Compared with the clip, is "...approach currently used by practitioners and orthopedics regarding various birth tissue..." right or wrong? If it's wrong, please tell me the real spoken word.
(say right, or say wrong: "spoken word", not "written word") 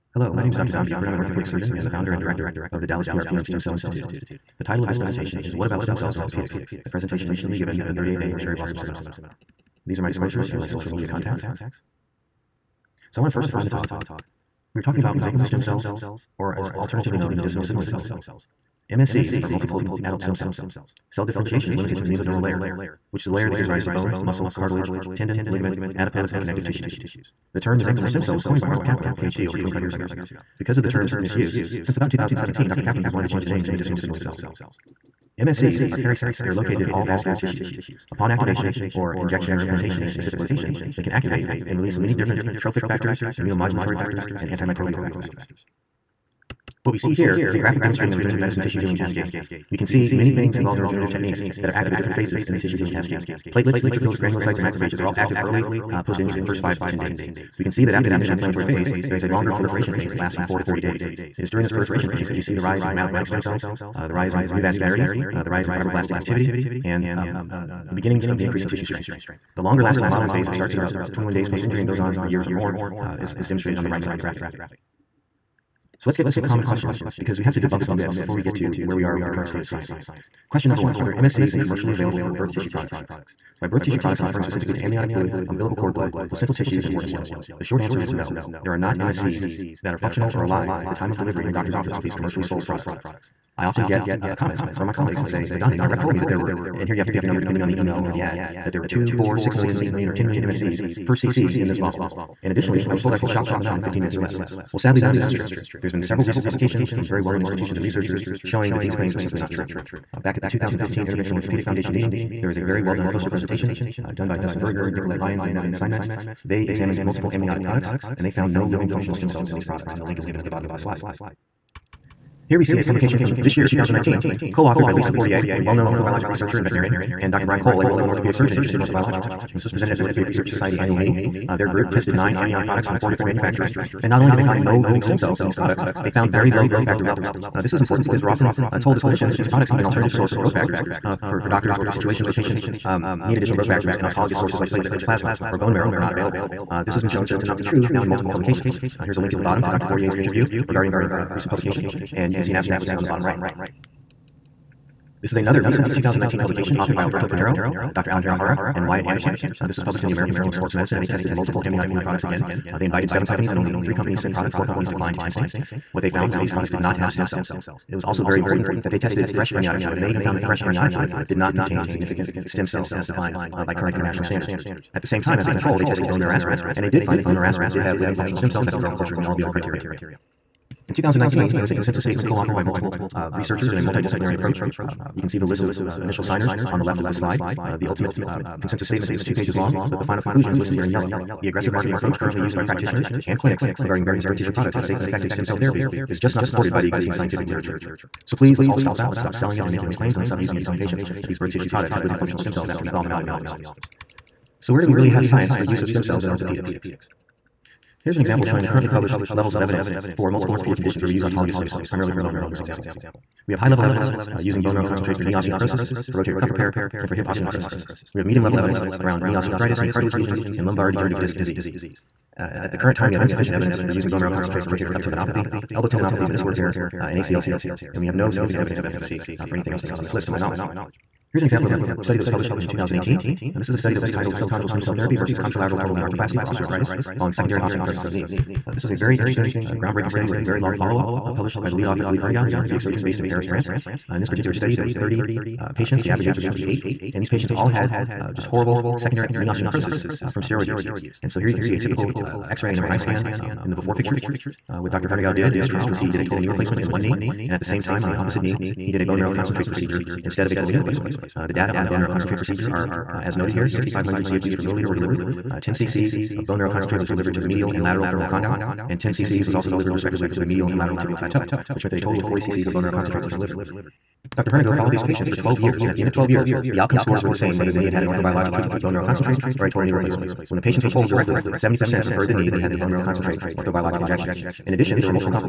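wrong: "clinics", not "orthopedics".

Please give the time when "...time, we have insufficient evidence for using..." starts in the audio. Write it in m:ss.
3:42.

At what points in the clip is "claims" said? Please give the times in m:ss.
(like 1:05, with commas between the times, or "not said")
1:48, 3:19.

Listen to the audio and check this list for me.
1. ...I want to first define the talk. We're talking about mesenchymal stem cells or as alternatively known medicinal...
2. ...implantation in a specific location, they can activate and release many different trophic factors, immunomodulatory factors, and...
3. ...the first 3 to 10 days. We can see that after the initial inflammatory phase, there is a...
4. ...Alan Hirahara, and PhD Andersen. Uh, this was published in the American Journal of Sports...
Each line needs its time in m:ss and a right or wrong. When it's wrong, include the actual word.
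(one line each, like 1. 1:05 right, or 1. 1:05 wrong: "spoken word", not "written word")
1. 0:13 right
2. 0:39 right
3. 0:56 wrong: "5", not "3"
4. 2:38 wrong: "Wyatt", not "PhD".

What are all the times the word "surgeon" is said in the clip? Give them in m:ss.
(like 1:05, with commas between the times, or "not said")
0:01, 2:08, 4:02.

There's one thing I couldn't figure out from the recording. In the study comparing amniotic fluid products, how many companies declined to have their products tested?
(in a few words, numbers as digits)
4.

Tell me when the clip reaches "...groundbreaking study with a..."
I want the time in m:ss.
3:59.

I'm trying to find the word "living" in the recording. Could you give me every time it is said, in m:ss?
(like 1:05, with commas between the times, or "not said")
1:58, 2:14, 2:57, 3:22.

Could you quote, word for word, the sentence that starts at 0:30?
Because of the term's misuse, since about 2017, Dr.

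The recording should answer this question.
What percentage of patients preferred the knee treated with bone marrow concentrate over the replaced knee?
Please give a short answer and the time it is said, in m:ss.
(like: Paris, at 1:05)
70%, at 4:41.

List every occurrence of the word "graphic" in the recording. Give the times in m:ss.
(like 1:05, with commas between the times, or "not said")
0:47, 1:14.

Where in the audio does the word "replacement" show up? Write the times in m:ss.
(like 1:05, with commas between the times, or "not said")
4:16, 4:20, 4:39.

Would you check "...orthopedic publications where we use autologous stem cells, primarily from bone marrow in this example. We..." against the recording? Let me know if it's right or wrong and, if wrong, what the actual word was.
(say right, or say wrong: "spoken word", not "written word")
wrong: "conditions", not "publications".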